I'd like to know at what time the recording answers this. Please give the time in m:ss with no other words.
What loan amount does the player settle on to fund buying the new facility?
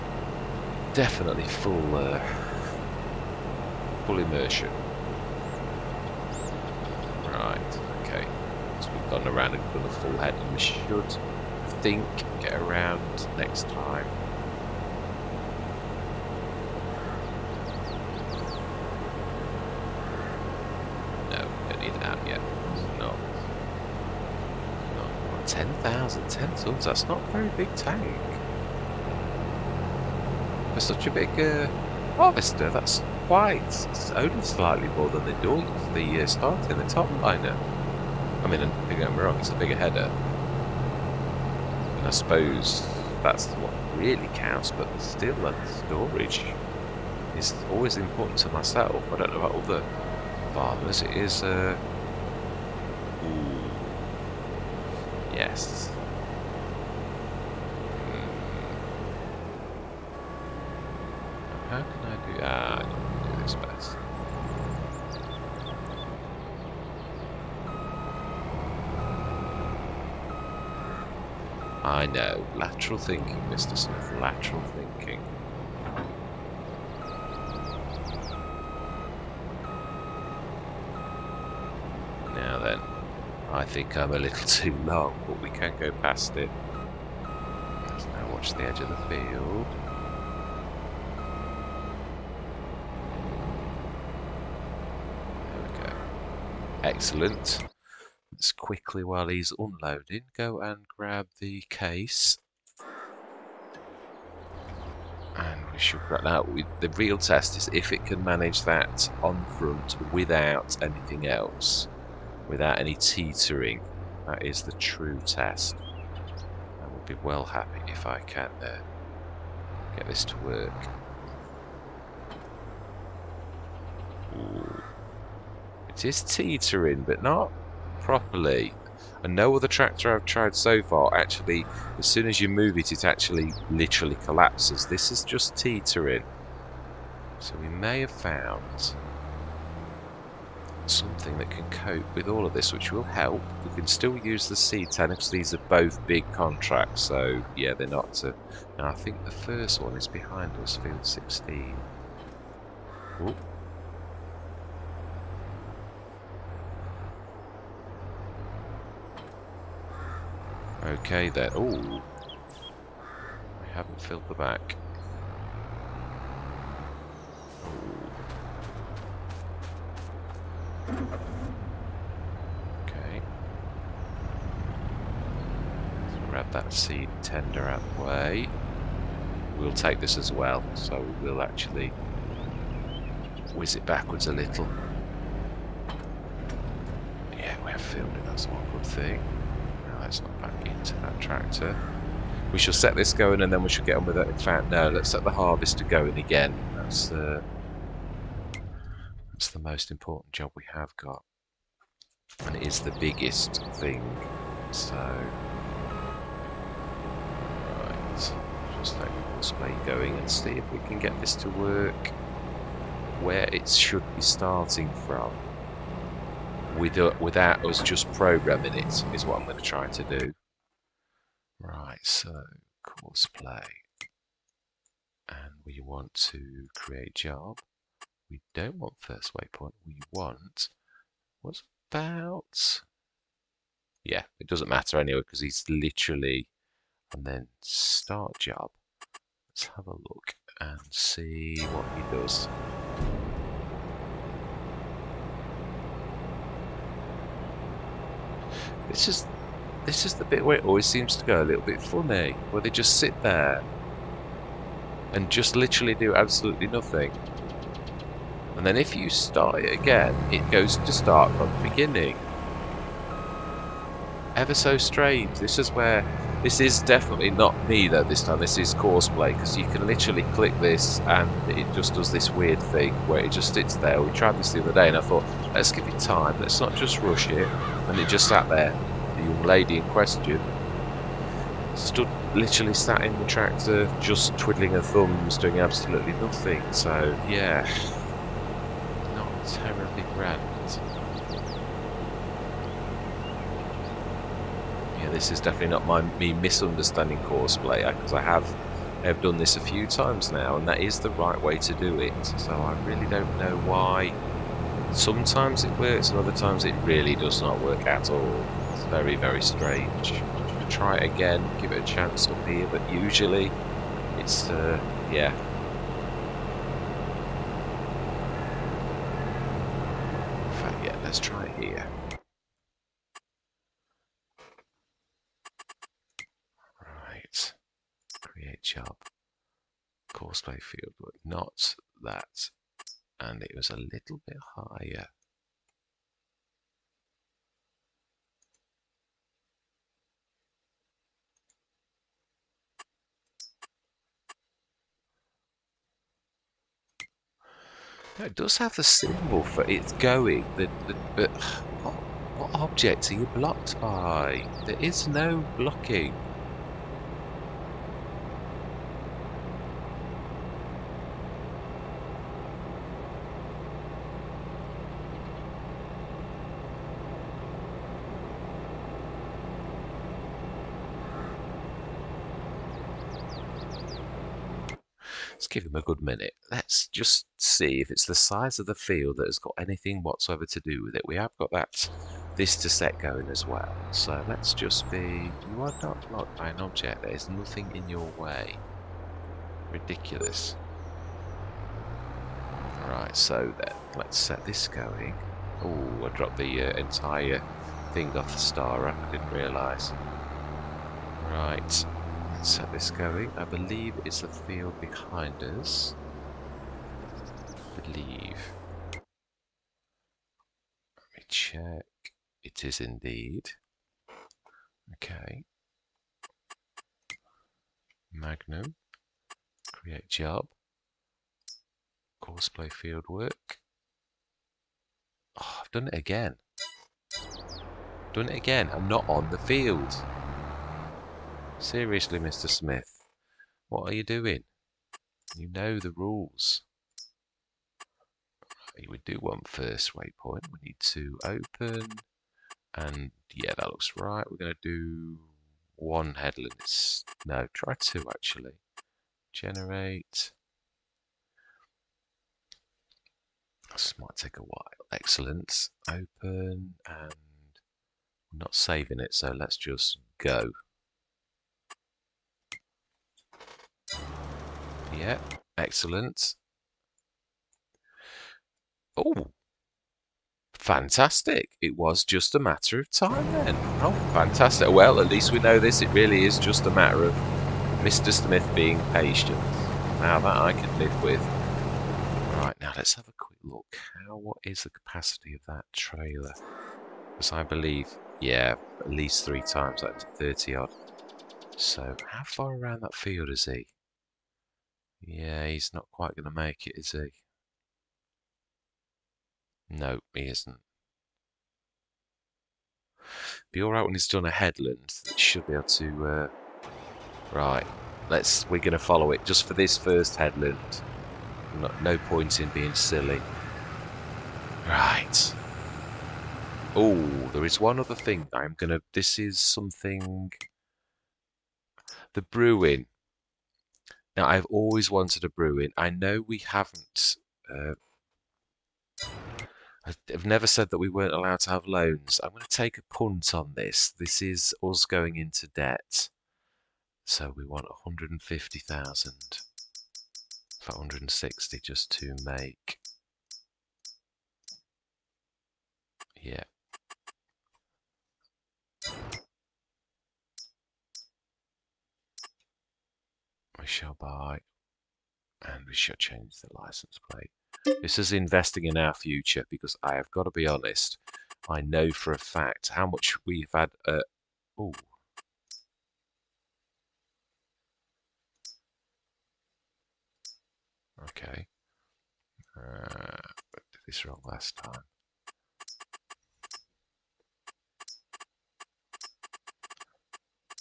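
9:00.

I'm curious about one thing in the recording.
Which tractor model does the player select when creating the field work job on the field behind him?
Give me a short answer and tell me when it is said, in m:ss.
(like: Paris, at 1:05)
Magnum, at 6:58.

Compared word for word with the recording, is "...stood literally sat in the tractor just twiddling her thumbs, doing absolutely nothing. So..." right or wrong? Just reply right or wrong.
right.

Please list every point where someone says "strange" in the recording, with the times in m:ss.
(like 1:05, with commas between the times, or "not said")
4:24, 5:09.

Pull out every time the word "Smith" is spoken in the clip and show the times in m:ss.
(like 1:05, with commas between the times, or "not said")
1:13, 7:12, 7:58.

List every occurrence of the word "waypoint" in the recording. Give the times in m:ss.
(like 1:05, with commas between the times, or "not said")
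3:49, 7:19.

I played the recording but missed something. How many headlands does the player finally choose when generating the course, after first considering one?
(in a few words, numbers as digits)
2.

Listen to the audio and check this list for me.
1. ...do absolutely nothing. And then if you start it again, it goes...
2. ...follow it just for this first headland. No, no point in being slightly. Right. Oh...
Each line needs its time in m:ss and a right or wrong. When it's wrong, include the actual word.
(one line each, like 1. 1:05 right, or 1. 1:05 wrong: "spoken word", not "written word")
1. 4:15 right
2. 8:28 wrong: "silly", not "slightly".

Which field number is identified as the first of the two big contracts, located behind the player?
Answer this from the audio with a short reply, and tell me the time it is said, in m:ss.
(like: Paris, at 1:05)
16, at 2:30.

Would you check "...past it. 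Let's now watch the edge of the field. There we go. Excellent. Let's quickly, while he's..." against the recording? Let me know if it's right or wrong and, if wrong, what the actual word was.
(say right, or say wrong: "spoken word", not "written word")
right.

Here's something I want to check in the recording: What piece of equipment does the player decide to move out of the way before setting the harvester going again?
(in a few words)
seed tender.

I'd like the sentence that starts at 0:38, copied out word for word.
I mean, don't get me wrong, it's a bigger header.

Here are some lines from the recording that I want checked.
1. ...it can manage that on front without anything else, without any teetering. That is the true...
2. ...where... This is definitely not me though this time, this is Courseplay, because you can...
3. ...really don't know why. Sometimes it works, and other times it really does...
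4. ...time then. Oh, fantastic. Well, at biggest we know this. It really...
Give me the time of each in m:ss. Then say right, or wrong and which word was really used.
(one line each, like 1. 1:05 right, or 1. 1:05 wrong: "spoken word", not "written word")
1. 1:47 right
2. 4:25 right
3. 5:02 right
4. 7:52 wrong: "least", not "biggest".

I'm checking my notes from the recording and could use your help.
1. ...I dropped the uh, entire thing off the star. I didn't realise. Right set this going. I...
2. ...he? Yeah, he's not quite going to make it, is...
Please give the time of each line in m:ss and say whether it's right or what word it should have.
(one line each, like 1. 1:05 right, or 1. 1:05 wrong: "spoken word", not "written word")
1. 6:36 right
2. 8:13 right.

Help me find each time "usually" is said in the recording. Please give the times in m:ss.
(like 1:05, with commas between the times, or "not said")
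5:12.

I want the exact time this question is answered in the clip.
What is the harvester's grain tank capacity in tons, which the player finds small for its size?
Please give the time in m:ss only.
0:26.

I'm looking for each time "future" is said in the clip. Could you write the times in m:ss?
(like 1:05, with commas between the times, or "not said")
9:18.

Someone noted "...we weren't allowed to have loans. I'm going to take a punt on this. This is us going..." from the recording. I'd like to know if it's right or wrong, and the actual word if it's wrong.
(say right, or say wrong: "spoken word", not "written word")
right.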